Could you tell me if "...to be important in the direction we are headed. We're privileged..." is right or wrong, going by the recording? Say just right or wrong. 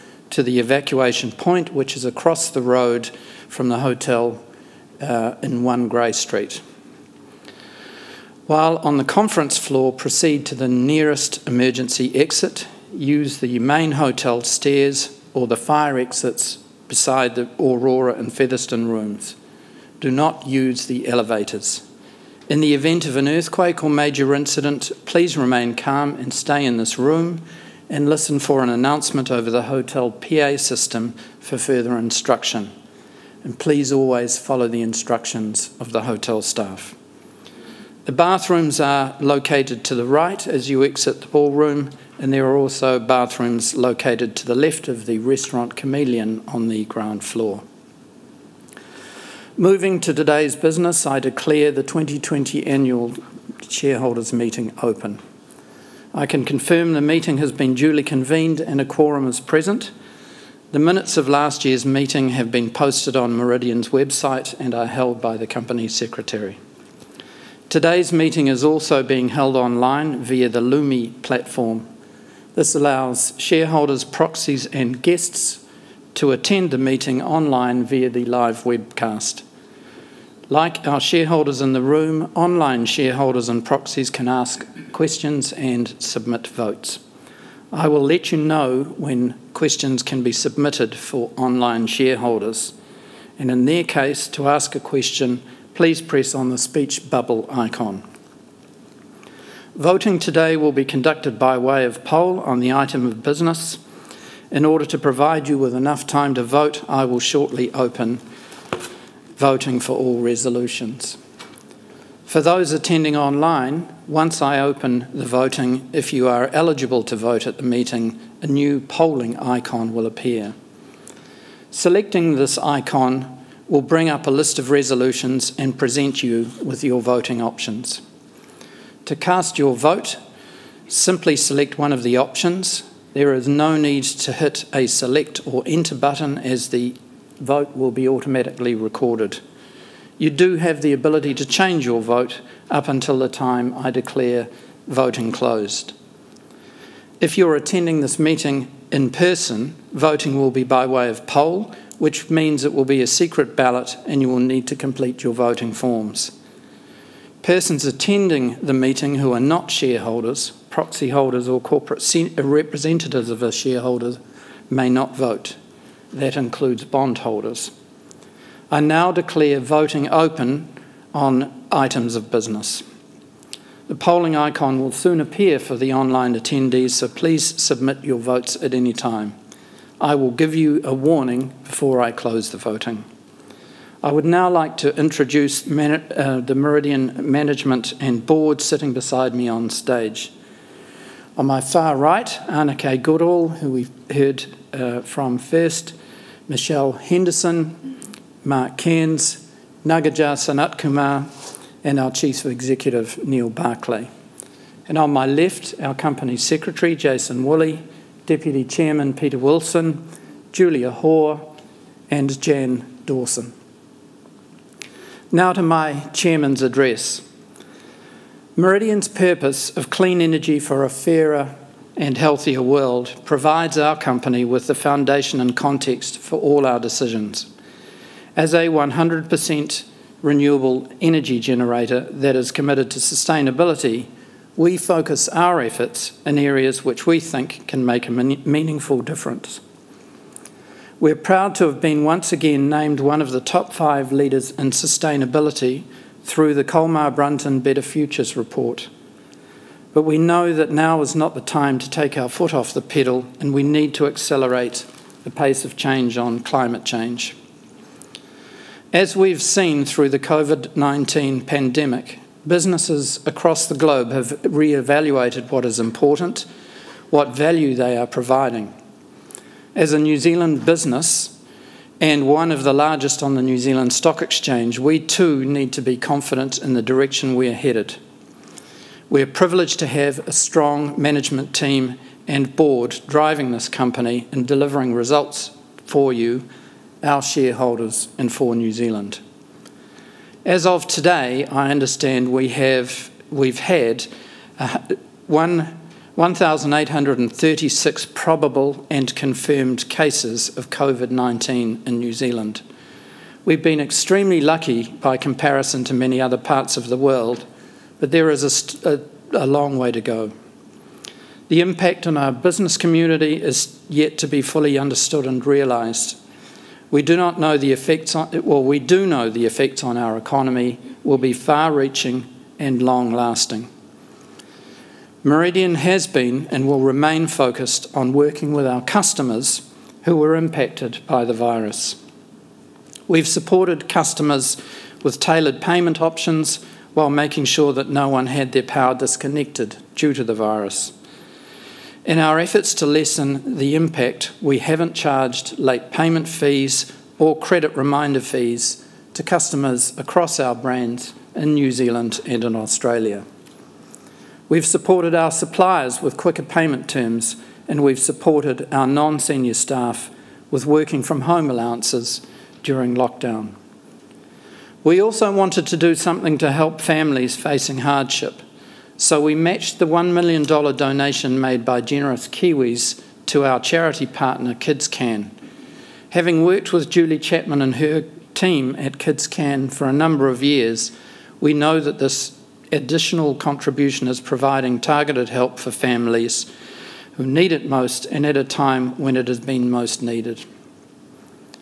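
wrong.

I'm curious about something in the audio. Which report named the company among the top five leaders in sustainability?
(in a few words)
Colmar Brunton Better Futures.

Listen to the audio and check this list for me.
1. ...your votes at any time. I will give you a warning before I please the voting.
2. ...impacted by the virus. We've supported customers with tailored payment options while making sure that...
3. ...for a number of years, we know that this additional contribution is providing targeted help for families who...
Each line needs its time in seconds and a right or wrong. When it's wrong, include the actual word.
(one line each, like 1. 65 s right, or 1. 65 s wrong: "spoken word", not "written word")
1. 178 s wrong: "close", not "please"
2. 330 s right
3. 379 s right.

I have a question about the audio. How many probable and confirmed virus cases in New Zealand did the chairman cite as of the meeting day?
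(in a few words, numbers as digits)
1,836.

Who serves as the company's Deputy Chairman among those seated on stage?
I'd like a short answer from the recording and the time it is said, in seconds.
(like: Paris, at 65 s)
Peter Wilson, at 209 s.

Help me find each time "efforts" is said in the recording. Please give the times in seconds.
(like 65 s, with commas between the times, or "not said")
235 s, 342 s.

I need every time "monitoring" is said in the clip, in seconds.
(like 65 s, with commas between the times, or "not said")
not said.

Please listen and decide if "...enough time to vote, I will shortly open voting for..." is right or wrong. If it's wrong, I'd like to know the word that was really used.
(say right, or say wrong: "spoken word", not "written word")
right.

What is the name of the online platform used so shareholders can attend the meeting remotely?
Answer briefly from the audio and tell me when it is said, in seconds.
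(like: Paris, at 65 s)
Lumi, at 70 s.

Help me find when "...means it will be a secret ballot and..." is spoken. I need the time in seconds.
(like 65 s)
152 s.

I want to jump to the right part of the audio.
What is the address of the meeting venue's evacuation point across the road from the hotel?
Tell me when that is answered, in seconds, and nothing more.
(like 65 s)
5 s.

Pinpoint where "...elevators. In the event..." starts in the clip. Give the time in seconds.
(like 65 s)
21 s.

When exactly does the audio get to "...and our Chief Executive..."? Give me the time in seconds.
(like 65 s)
201 s.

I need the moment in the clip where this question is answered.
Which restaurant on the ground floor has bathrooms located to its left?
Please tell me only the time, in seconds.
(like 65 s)
45 s.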